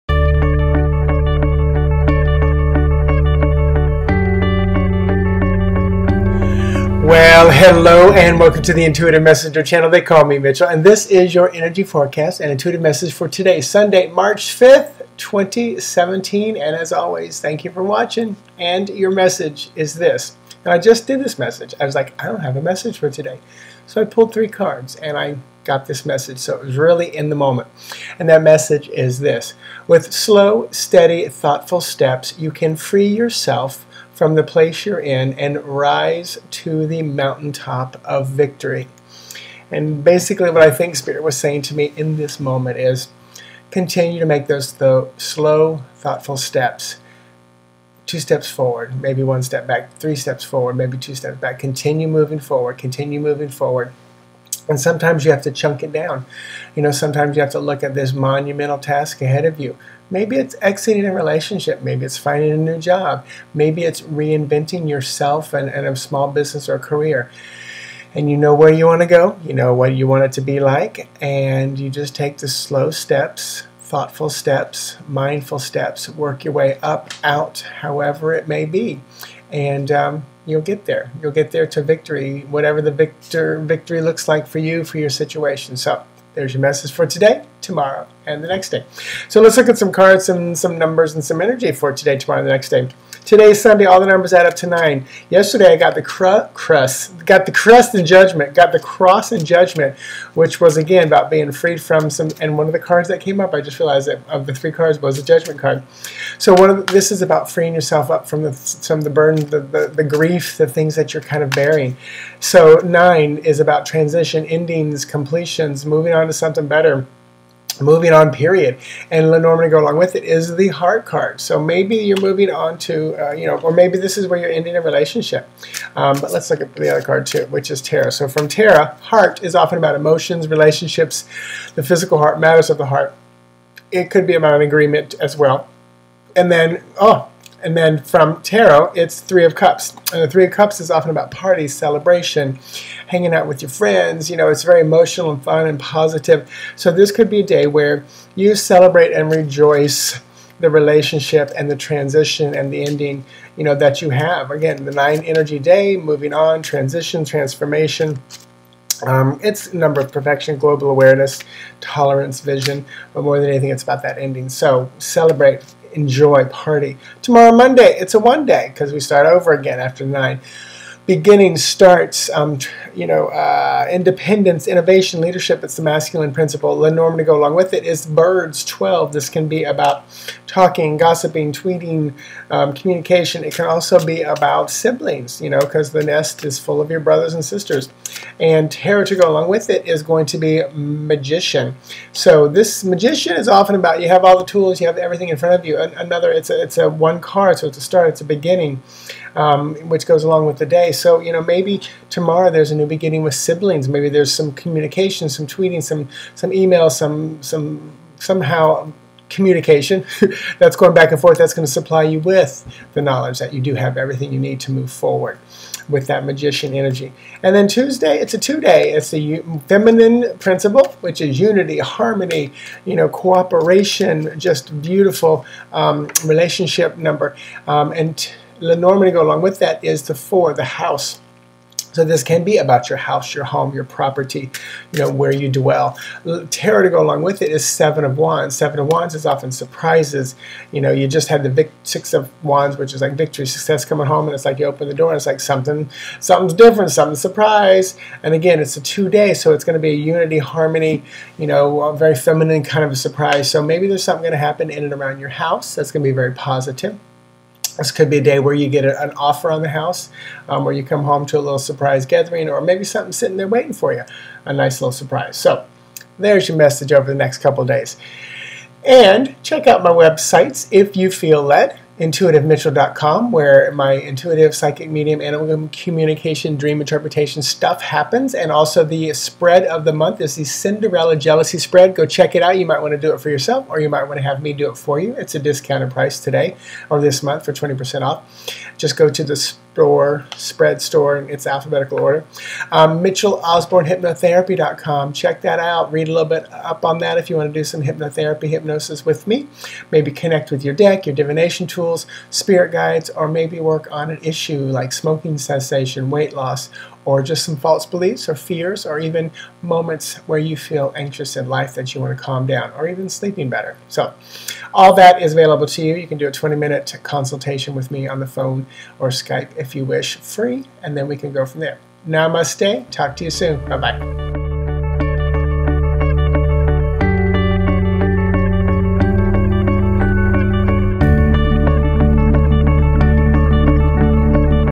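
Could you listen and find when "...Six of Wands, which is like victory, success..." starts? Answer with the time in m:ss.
4:01.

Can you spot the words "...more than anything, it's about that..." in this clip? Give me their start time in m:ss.
2:43.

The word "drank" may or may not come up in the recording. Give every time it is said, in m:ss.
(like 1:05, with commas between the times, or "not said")
not said.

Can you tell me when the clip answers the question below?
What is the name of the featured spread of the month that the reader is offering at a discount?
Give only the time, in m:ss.
4:40.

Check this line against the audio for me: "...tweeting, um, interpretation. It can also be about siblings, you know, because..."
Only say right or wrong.
wrong.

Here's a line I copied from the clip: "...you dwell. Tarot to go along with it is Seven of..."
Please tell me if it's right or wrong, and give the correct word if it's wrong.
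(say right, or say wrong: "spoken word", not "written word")
right.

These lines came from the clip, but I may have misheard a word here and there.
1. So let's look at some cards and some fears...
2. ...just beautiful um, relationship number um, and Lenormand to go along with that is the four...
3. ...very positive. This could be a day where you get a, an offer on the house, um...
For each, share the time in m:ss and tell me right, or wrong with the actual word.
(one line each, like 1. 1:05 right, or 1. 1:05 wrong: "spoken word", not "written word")
1. 1:29 wrong: "numbers", not "fears"
2. 3:44 right
3. 4:16 right.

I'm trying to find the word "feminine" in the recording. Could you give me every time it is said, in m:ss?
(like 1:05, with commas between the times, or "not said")
3:39, 4:12.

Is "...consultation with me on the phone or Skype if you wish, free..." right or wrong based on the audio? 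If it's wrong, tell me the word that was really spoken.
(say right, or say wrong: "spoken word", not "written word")
right.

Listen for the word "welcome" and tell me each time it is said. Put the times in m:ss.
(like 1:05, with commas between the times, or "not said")
0:08.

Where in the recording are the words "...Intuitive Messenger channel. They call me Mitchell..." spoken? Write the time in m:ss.
0:08.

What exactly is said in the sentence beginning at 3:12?
So this magician is often about you have all the tools, you have everything in front of you.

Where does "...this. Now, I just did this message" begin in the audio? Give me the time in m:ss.
0:19.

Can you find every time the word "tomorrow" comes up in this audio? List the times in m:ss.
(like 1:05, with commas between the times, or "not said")
1:27, 1:32, 2:47, 3:22.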